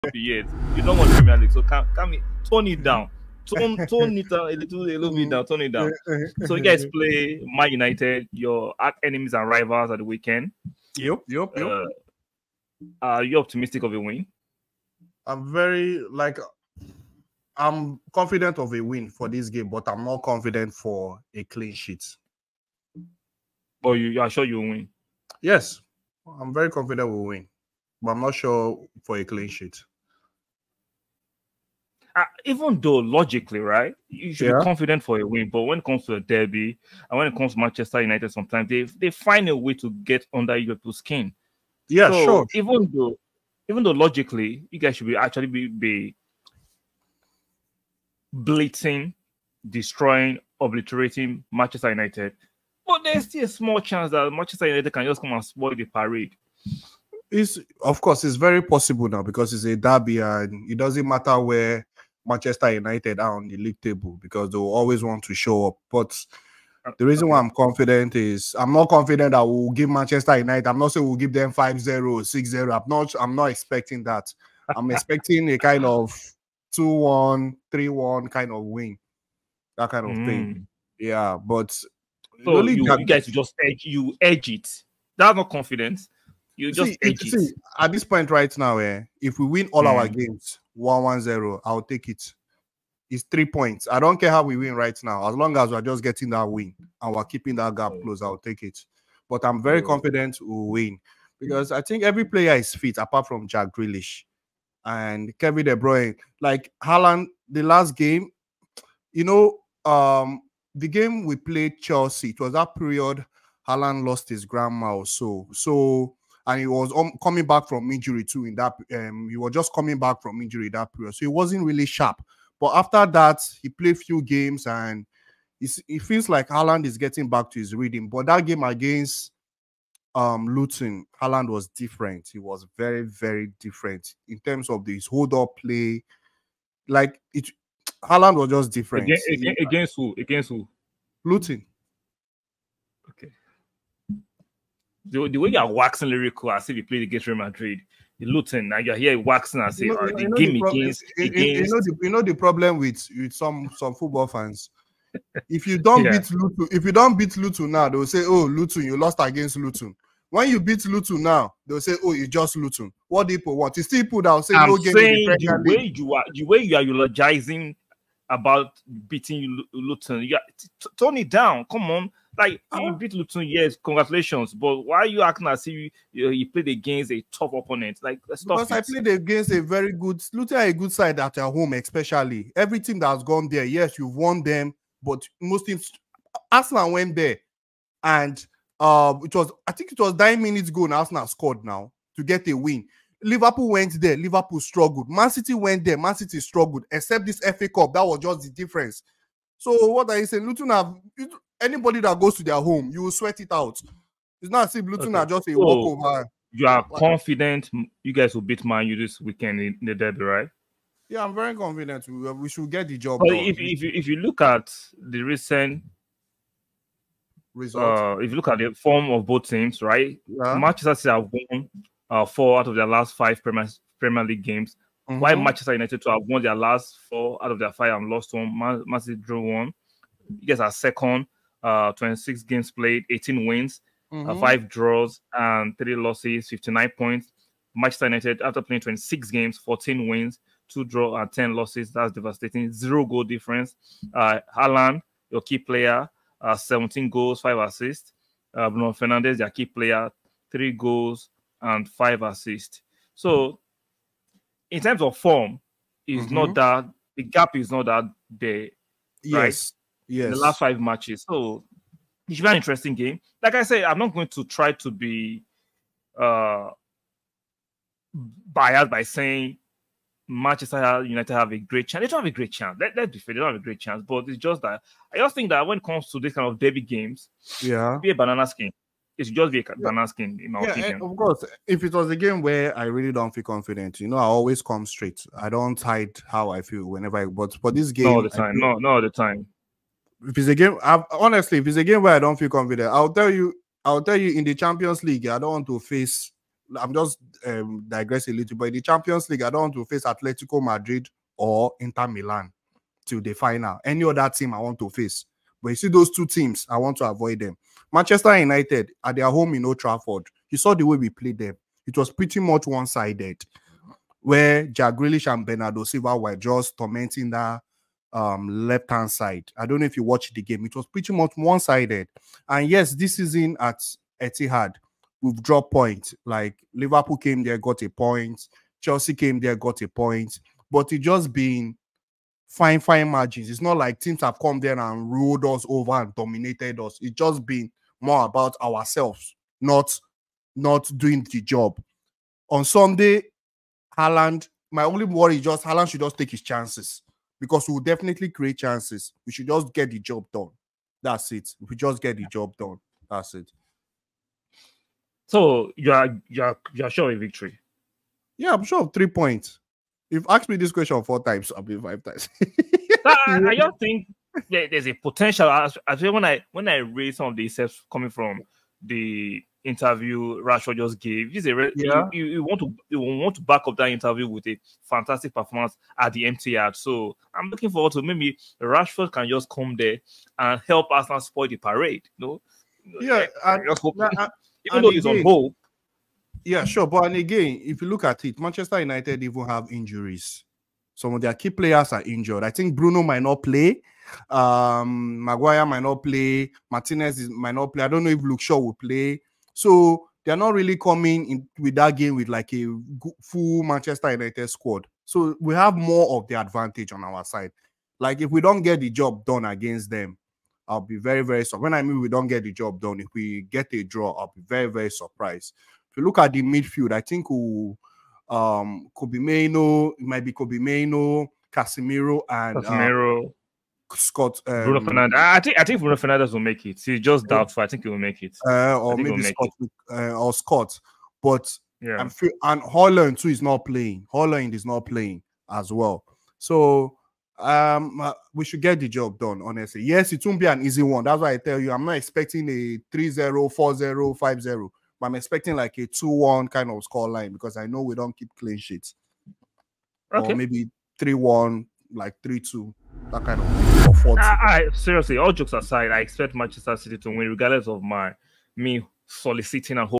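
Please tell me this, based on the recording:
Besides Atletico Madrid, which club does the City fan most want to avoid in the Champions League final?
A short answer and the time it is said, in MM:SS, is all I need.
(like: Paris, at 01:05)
Inter Milan, at 05:01.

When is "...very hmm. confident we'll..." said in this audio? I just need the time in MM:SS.
01:39.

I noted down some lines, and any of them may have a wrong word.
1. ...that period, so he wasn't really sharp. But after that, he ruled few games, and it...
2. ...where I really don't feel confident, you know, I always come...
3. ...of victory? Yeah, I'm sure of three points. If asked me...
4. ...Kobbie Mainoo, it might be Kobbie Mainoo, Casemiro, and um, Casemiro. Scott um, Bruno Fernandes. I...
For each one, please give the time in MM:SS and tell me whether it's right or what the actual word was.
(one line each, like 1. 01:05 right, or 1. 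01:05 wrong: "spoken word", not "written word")
1. 02:00 wrong: "played", not "ruled"
2. 04:42 right
3. 05:57 right
4. 06:58 right.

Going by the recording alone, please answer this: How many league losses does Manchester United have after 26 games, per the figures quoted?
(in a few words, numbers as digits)
10.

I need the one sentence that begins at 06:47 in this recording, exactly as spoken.
Like if we don't get the job done against them, I'll be very, very surprised.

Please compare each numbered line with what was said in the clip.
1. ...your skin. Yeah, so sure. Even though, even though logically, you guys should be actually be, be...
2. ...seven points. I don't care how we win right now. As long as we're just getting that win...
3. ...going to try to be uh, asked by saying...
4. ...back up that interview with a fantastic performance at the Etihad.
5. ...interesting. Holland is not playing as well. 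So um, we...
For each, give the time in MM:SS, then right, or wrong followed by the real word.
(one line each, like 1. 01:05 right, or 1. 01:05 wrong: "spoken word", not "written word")
1. 00:40 right
2. 01:33 wrong: "three", not "seven"
3. 04:24 wrong: "biased", not "asked"
4. 06:13 right
5. 07:13 wrong: "playing", not "interesting".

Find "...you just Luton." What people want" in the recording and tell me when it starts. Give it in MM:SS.
02:42.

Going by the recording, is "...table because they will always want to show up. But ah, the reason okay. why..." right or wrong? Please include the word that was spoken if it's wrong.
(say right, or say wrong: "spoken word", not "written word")
right.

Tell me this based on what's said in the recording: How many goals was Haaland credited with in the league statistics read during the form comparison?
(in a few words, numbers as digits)
17.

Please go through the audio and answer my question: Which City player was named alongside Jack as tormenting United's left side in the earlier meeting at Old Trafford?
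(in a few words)
Bernardo Silva.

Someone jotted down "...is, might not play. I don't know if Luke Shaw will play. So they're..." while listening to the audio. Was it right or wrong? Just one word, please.
right.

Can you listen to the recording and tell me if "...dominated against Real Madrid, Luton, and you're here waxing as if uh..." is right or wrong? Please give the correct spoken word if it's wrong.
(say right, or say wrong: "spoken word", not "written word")
wrong: "played", not "dominated".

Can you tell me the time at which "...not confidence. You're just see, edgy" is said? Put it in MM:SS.
01:25.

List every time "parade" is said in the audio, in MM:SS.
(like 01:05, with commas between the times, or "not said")
00:55, 06:21.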